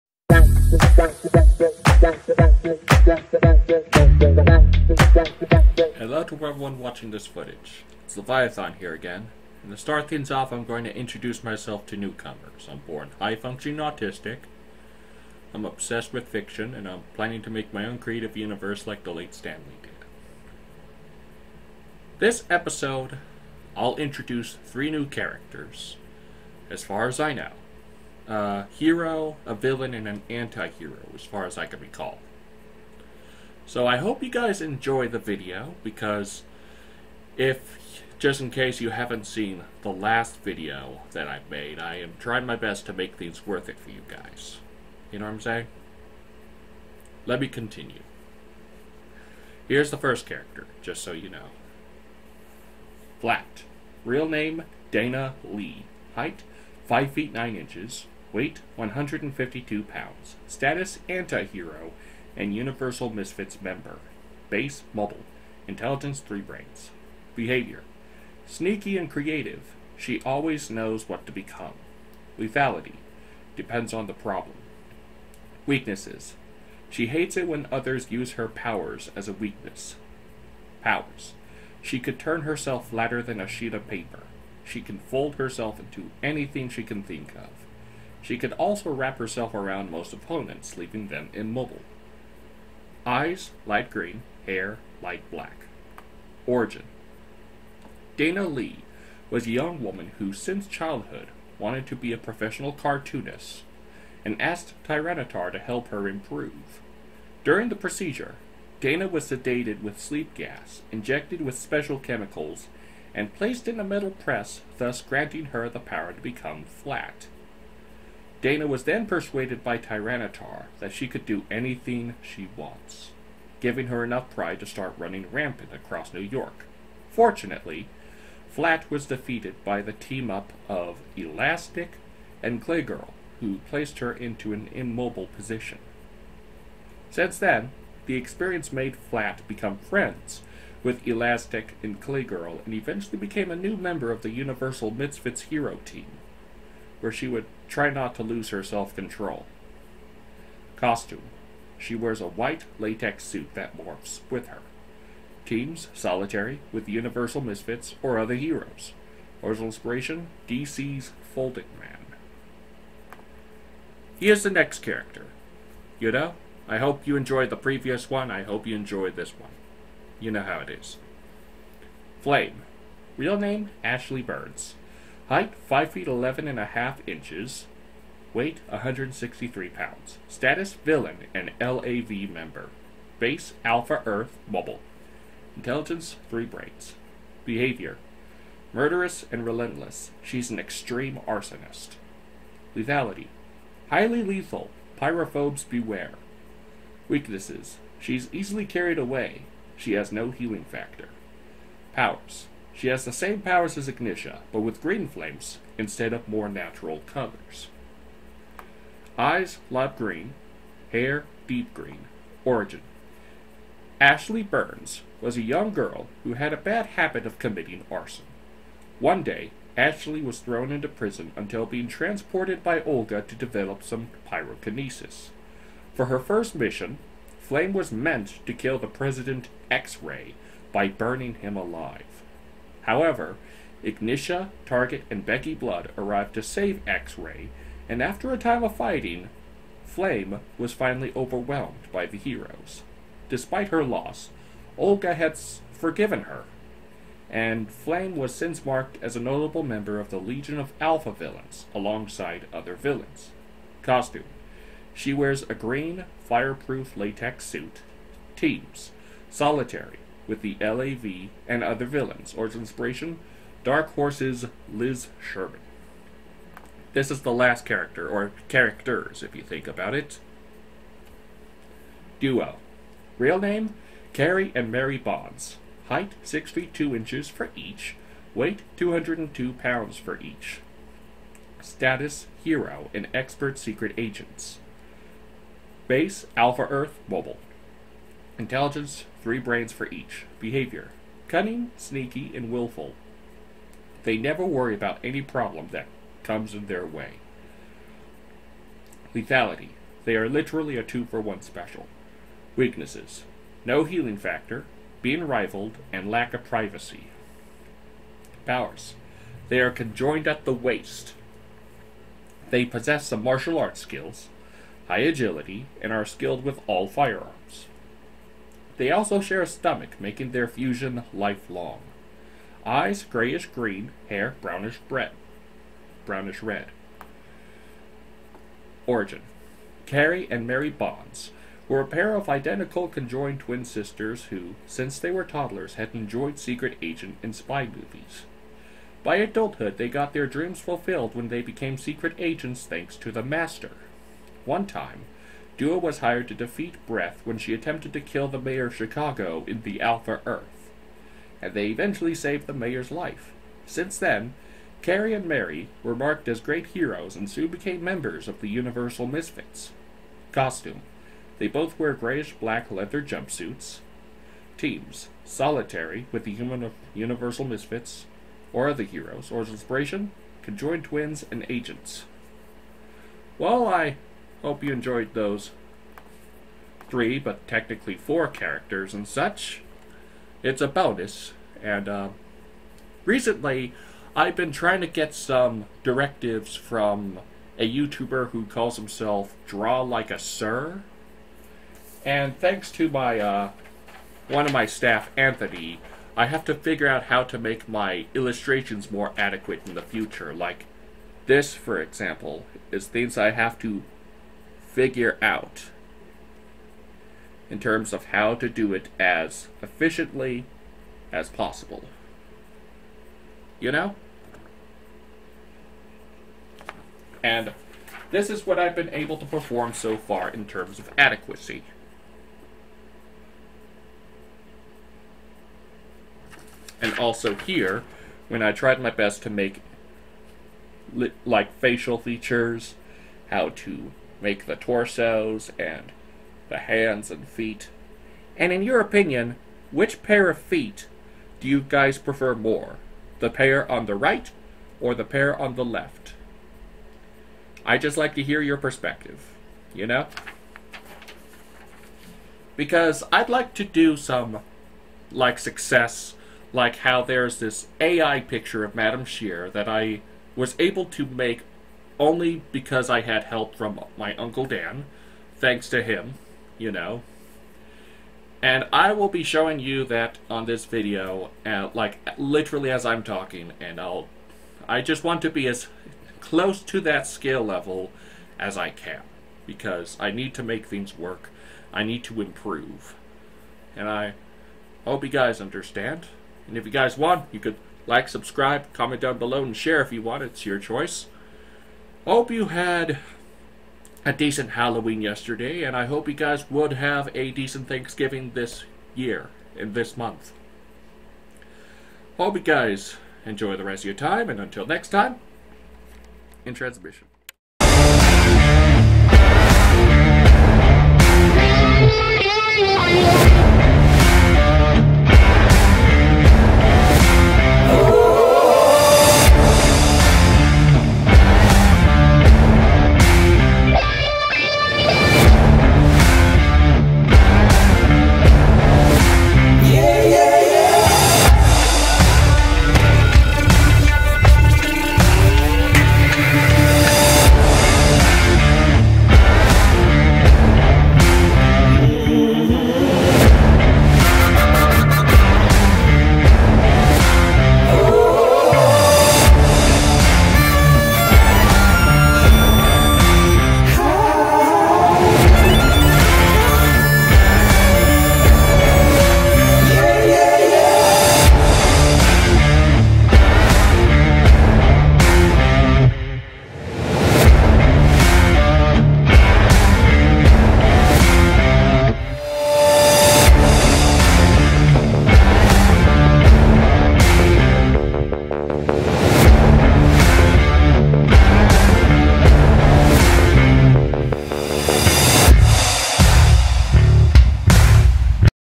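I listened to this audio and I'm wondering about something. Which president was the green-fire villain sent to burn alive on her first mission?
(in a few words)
X-Ray.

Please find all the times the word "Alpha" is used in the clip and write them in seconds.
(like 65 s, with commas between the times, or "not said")
183 s, 250 s, 286 s, 349 s.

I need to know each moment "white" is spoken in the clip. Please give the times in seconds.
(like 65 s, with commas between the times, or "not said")
152 s.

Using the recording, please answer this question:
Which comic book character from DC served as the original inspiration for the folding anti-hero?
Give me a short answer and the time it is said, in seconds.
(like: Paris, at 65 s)
Folding Man, at 160 s.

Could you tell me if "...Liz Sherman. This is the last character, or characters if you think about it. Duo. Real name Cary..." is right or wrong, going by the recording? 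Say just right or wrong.
right.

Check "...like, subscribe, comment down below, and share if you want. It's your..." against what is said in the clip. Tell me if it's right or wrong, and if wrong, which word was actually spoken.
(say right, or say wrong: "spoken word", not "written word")
right.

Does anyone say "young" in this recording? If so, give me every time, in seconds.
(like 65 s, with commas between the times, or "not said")
99 s, 215 s.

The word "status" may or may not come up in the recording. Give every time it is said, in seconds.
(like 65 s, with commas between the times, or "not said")
60 s, 180 s, 281 s.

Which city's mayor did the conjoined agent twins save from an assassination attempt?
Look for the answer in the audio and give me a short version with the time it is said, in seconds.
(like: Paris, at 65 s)
Chicago, at 348 s.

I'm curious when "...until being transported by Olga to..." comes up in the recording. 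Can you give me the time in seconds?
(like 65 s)
221 s.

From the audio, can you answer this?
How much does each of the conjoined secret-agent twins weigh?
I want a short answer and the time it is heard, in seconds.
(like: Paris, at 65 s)
202 pounds, at 278 s.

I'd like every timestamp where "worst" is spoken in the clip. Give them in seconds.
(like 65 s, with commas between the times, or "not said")
not said.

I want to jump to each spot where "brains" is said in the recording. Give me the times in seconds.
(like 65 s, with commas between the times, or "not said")
66 s, 186 s, 289 s.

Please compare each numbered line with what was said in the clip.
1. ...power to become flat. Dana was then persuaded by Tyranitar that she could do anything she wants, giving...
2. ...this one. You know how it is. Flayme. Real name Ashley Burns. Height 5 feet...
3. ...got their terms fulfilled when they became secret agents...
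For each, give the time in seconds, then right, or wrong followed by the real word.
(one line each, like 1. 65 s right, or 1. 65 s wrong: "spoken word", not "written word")
1. 115 s right
2. 169 s right
3. 339 s wrong: "dreams", not "terms".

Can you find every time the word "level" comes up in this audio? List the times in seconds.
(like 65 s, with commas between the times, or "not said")
477 s.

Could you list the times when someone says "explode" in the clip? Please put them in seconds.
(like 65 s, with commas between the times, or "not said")
not said.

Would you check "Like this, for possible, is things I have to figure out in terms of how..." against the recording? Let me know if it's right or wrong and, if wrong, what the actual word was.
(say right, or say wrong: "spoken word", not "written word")
wrong: "example", not "possible".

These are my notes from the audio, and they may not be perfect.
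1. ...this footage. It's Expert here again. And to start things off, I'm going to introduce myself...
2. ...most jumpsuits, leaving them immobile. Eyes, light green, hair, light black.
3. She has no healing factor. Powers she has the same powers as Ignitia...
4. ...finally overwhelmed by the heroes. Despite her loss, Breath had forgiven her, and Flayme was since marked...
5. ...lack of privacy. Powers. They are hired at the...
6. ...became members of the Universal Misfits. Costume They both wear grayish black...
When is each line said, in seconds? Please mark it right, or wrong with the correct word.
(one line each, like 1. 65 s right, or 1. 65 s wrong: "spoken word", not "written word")
1. 7 s wrong: "Leviathan", not "Expert"
2. 89 s wrong: "opponents", not "jumpsuits"
3. 199 s right
4. 240 s wrong: "Olga", not "Breath"
5. 306 s wrong: "conjoined", not "hired"
6. 357 s right.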